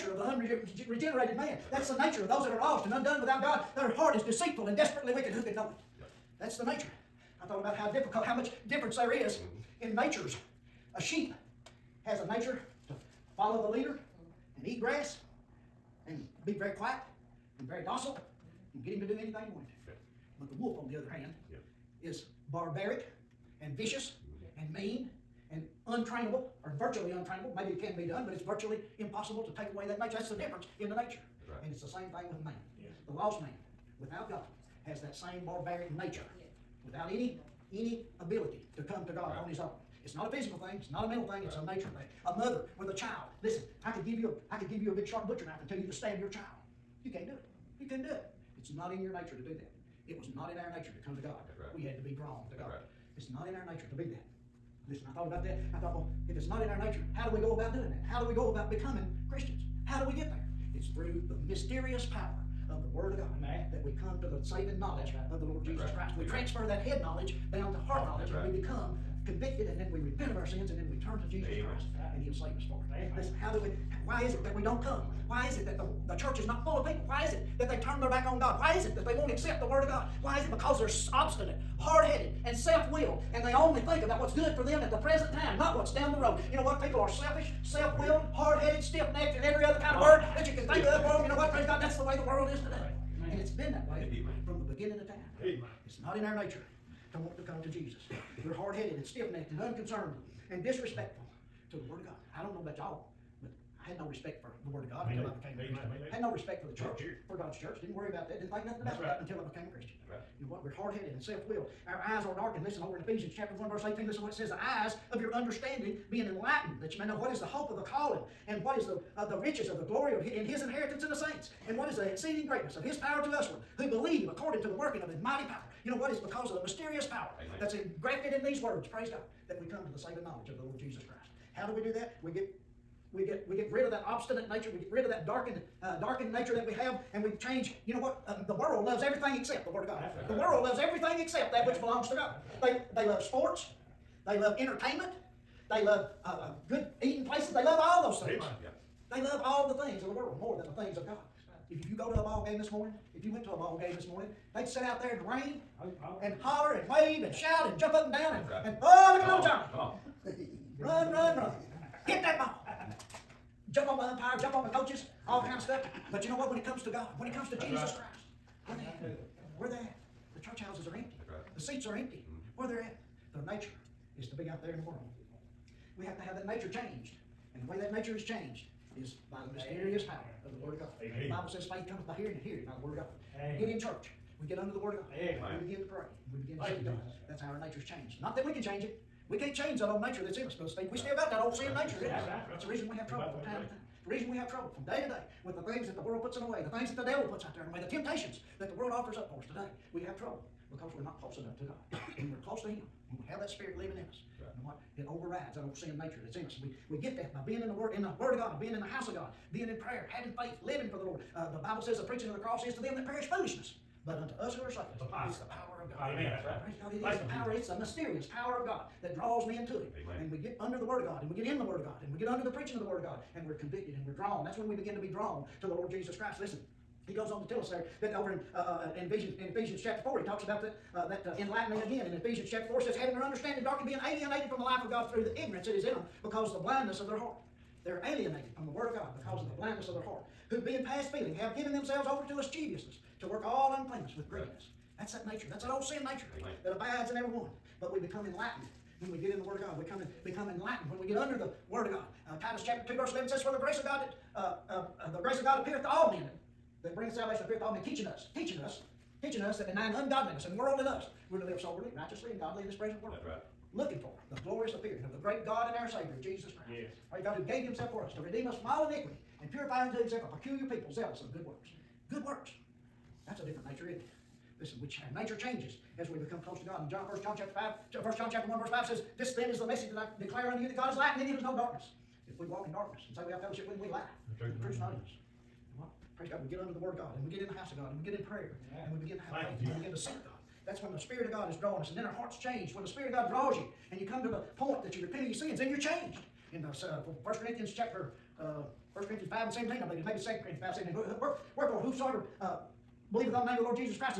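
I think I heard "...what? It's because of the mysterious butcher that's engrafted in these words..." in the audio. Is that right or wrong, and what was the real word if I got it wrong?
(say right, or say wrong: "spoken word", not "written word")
wrong: "power", not "butcher".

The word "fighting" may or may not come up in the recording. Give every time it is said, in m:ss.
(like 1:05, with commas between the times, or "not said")
not said.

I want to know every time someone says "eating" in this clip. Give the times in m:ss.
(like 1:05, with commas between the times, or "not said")
2:27.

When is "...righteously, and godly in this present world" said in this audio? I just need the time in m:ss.
4:21.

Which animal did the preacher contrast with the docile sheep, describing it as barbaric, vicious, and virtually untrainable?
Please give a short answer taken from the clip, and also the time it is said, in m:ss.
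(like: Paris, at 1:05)
Wolf, at 0:20.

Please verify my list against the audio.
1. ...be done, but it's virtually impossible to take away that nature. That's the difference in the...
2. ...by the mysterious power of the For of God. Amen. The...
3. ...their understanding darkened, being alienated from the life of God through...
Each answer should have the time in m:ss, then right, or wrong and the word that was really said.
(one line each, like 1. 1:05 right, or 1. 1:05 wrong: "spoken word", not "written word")
1. 0:27 right
2. 2:59 wrong: "Word", not "For"
3. 3:53 right.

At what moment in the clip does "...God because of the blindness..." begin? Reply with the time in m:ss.
3:58.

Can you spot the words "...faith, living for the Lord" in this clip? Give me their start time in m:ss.
3:30.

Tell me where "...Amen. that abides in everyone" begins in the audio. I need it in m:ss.
4:06.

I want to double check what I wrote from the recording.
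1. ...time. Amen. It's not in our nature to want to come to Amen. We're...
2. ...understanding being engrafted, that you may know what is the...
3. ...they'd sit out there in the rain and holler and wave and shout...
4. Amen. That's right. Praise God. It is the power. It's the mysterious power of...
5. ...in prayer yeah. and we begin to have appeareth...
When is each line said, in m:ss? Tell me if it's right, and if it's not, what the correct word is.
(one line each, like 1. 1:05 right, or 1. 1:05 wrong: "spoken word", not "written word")
1. 1:35 wrong: "Jesus", not "Amen"
2. 1:55 wrong: "enlightened", not "engrafted"
3. 2:34 right
4. 3:36 right
5. 4:48 wrong: "faith", not "appeareth".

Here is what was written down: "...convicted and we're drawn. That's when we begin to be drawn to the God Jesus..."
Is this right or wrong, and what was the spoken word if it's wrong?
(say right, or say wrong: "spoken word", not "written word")
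wrong: "Lord", not "God".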